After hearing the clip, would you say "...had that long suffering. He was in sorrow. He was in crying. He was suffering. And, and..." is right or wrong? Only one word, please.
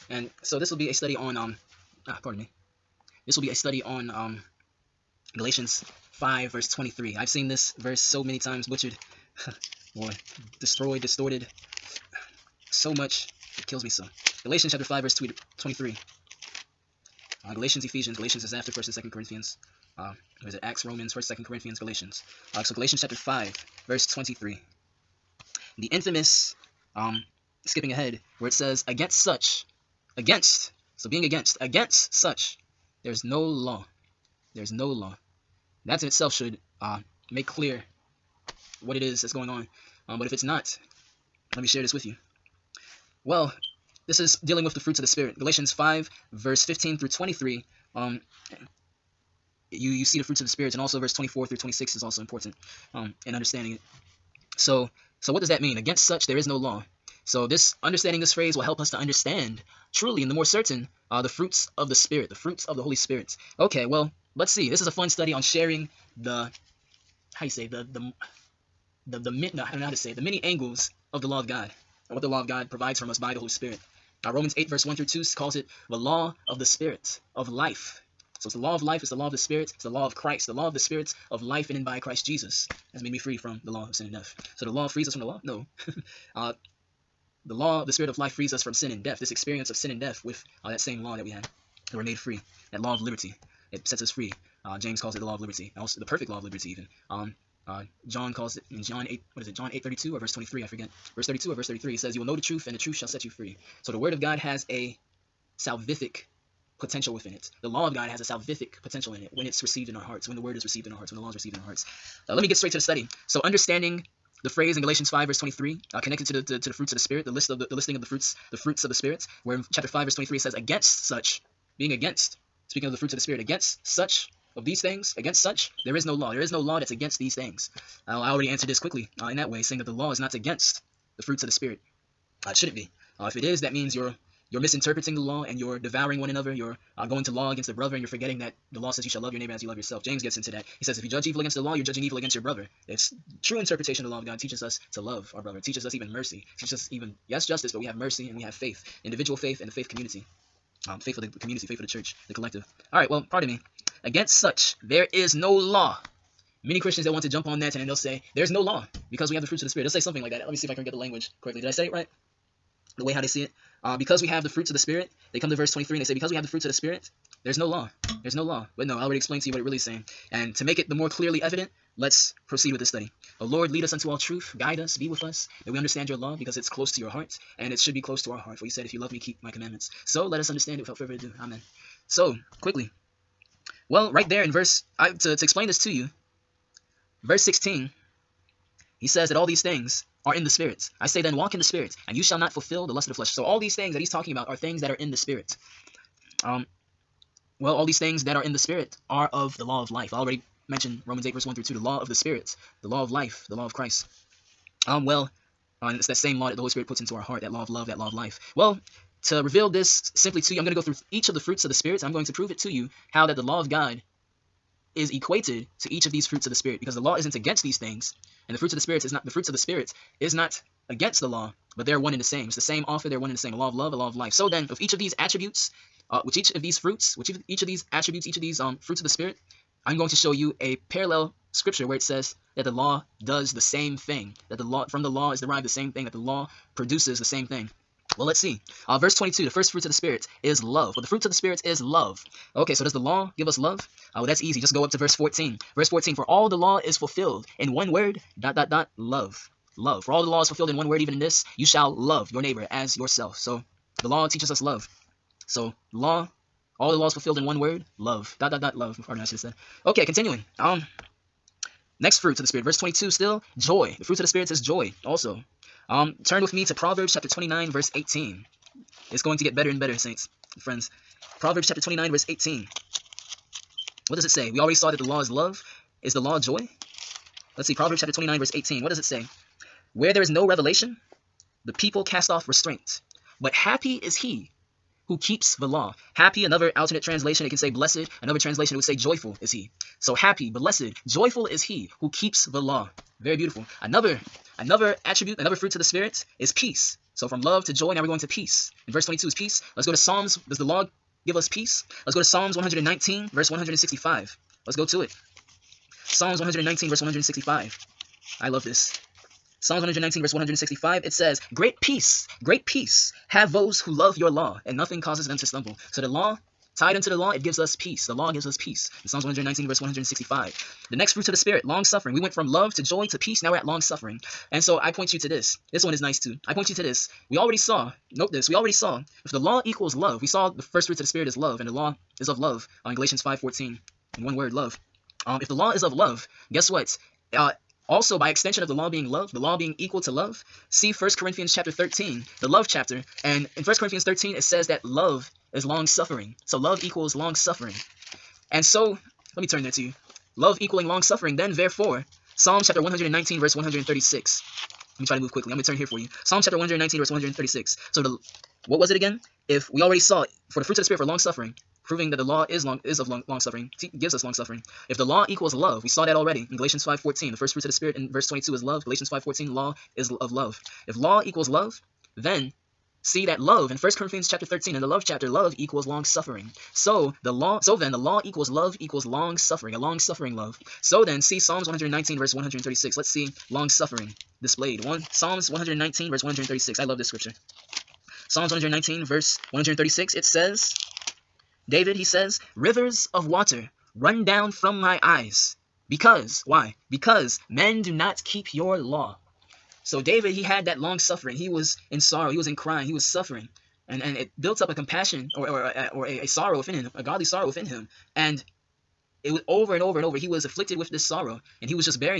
right.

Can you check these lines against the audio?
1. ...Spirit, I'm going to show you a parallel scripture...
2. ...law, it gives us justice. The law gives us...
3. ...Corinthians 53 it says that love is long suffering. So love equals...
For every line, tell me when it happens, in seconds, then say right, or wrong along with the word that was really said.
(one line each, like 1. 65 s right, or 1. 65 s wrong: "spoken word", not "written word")
1. 229 s right
2. 317 s wrong: "peace", not "justice"
3. 343 s wrong: "13", not "53".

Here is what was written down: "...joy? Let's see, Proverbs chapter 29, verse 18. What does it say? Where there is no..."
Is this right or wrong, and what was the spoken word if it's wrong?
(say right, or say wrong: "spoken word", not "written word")
right.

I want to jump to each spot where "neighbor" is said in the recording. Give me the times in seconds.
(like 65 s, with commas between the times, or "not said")
139 s, 252 s.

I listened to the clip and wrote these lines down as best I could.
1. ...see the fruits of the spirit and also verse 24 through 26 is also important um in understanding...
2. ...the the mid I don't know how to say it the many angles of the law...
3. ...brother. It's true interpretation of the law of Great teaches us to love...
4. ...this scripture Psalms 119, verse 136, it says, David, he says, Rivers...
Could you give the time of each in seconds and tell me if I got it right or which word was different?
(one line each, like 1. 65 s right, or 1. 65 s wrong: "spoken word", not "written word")
1. 50 s right
2. 69 s right
3. 142 s wrong: "God", not "Great"
4. 386 s right.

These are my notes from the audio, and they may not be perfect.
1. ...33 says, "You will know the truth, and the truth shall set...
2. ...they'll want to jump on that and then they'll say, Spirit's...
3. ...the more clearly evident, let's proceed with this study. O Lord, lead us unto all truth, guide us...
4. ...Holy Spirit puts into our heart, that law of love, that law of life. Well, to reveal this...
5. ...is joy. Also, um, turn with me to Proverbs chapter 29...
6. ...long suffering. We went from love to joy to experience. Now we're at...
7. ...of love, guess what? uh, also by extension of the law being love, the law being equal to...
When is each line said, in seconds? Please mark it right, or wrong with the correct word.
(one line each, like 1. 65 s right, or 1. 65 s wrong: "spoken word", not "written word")
1. 101 s right
2. 157 s wrong: "There", not "Spirit"
3. 170 s right
4. 206 s right
5. 264 s right
6. 321 s wrong: "peace", not "experience"
7. 335 s right.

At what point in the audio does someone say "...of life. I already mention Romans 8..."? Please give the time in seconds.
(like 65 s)
199 s.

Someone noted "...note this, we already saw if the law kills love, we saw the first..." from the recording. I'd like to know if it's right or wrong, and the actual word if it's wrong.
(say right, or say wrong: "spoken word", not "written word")
wrong: "equals", not "kills".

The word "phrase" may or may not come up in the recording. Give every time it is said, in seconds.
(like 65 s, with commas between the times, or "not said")
58 s, 114 s.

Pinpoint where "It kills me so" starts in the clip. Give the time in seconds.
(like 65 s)
13 s.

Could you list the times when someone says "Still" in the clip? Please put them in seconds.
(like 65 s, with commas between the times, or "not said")
263 s.